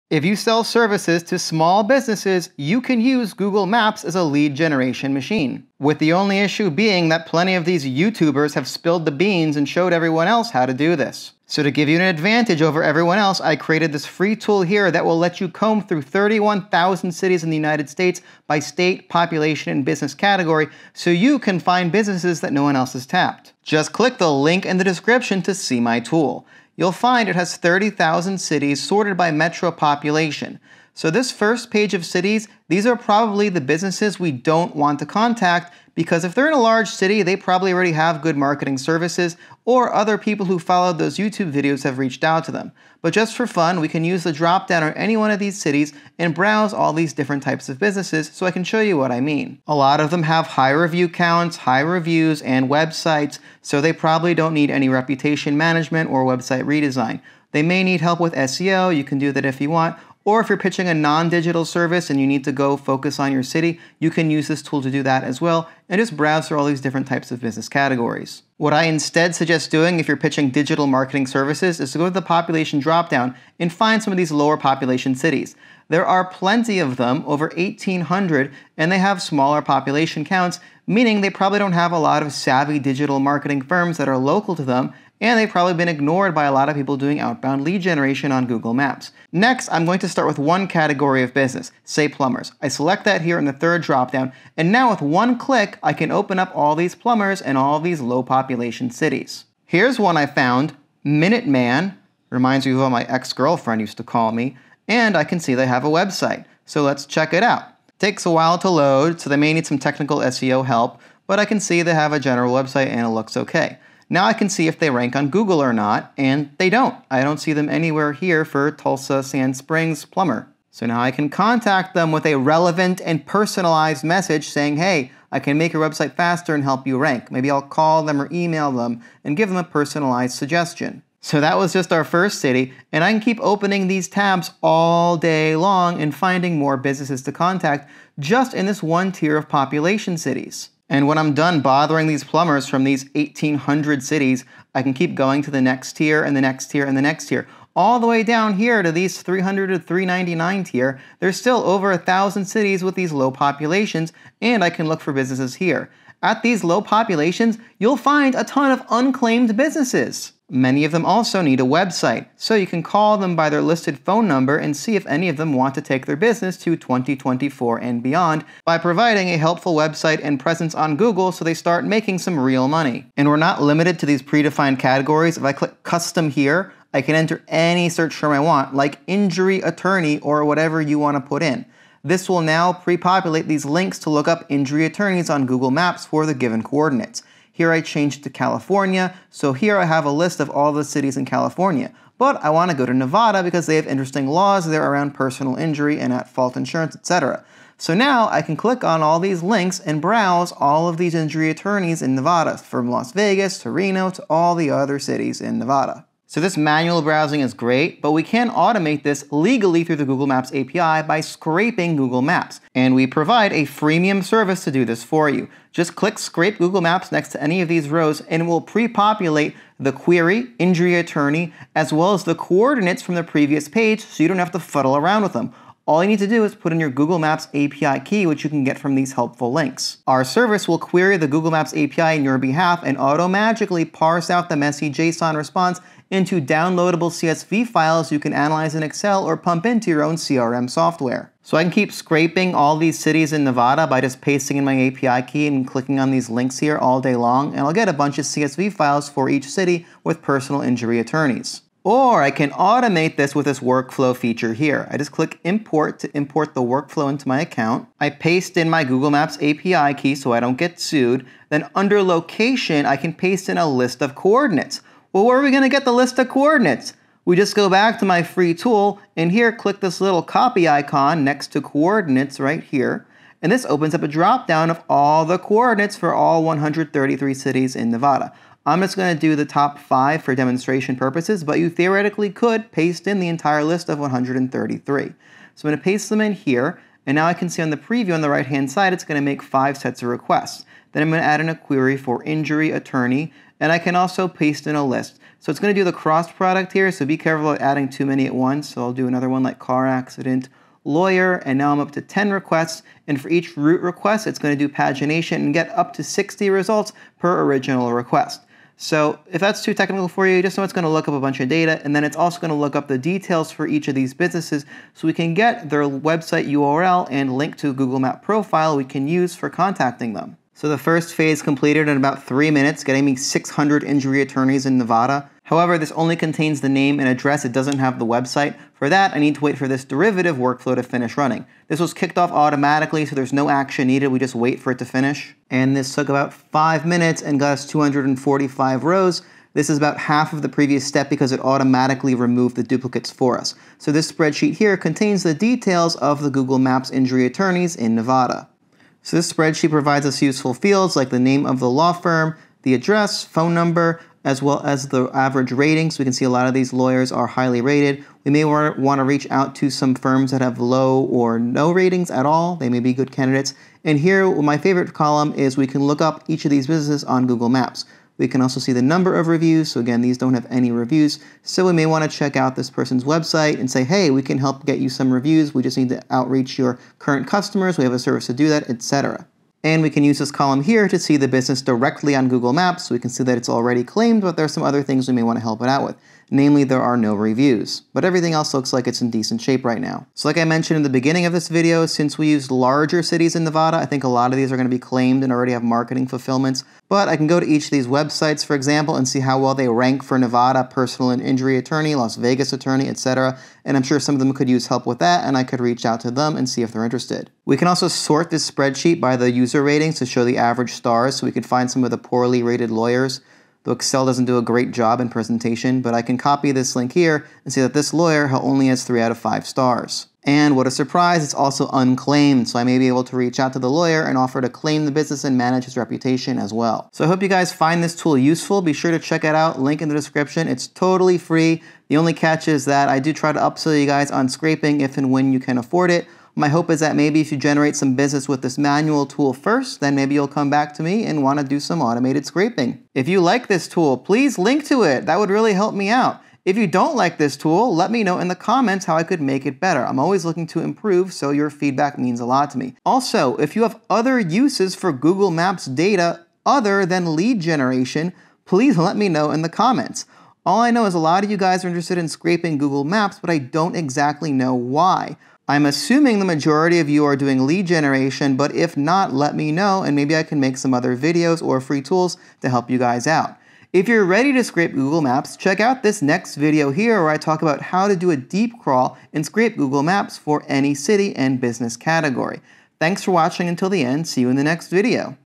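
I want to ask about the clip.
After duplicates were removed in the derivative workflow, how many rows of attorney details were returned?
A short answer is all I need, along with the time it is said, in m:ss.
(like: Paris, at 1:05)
245, at 5:37.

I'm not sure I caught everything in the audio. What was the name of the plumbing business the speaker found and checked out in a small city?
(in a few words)
Minuteman.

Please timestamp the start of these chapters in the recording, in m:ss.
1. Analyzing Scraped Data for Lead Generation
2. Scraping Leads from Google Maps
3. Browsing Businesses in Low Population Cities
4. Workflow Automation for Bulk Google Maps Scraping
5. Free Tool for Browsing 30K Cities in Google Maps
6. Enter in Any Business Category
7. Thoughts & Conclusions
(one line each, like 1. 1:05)
1. 5:49
2. 3:26
3. 1:08
4. 4:10
5. 0:23
6. 2:53
7. 7:07.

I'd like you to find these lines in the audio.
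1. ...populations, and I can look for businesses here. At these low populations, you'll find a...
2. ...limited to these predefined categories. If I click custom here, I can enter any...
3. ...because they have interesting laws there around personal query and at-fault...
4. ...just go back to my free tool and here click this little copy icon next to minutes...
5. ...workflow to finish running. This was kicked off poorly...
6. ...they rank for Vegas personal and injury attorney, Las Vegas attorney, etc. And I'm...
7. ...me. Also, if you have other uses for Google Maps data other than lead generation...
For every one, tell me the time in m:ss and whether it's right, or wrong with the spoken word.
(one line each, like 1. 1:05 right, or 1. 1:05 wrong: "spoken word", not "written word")
1. 2:33 right
2. 2:53 right
3. 3:13 wrong: "injury", not "query"
4. 4:27 wrong: "coordinates", not "minutes"
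5. 5:30 wrong: "automatically", not "poorly"
6. 6:39 wrong: "Nevada", not "Vegas"
7. 7:32 right.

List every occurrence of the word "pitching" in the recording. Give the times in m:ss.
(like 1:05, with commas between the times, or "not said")
1:00, 1:10.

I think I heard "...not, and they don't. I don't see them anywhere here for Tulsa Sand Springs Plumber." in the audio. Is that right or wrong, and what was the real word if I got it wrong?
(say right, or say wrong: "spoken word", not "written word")
right.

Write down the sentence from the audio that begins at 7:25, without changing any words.
That would really help me out.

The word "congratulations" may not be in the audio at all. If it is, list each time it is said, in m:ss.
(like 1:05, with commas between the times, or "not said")
not said.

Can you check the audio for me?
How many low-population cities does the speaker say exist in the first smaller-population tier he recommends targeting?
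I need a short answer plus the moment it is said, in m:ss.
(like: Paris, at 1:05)
1,800, at 1:17.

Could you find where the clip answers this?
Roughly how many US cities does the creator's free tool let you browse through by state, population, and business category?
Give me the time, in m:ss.
0:16.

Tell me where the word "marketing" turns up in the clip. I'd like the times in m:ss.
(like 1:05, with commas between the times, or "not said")
0:38, 1:10, 1:23, 6:35.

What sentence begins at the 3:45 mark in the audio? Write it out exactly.
All you need to do is put in your Google Maps API key, which you can get from these helpful links.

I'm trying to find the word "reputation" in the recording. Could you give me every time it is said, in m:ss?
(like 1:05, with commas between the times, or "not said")
0:54, 7:05.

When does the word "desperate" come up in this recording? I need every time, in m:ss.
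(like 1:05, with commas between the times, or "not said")
not said.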